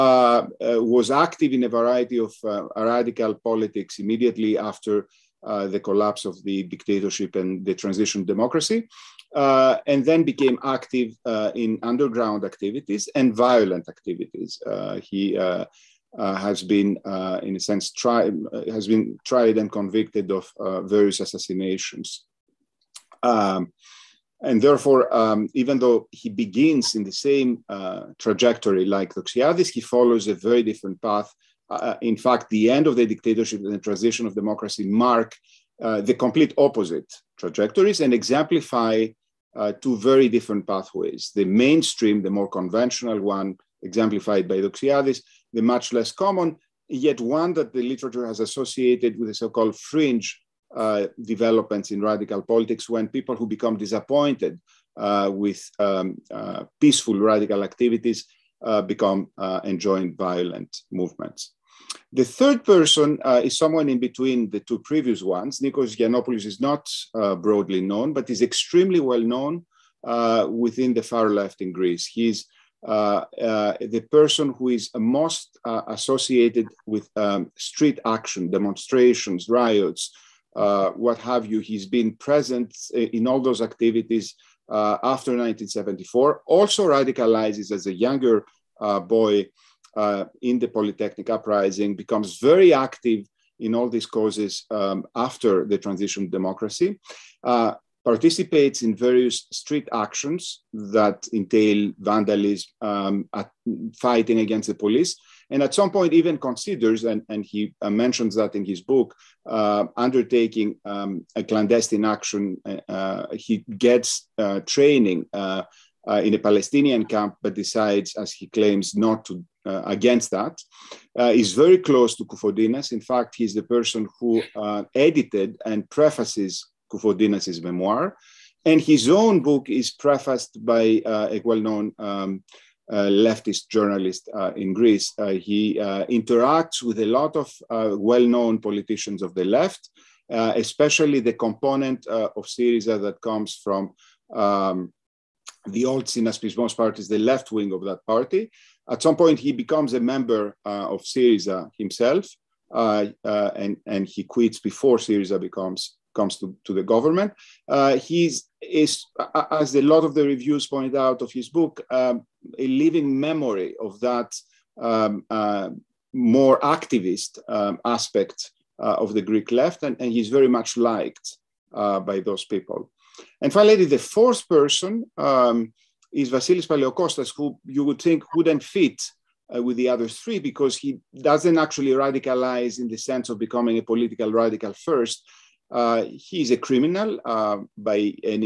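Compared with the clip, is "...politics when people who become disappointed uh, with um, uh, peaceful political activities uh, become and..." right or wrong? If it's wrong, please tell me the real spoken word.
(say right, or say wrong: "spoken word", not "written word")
wrong: "radical", not "political".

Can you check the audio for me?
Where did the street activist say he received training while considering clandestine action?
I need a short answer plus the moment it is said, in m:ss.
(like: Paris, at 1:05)
a Palestinian camp, at 1:56.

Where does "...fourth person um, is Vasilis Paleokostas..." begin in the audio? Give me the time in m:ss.
2:53.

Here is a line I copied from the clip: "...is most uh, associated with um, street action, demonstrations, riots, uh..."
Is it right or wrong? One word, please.
right.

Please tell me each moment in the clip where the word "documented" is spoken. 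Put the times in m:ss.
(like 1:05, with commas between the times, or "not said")
not said.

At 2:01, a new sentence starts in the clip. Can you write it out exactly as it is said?
Uh, is very close to Koufontinas.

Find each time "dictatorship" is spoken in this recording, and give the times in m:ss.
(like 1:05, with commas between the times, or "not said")
0:06, 0:33.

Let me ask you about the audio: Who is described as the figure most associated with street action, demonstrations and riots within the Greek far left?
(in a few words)
Nikos Giannopoulos.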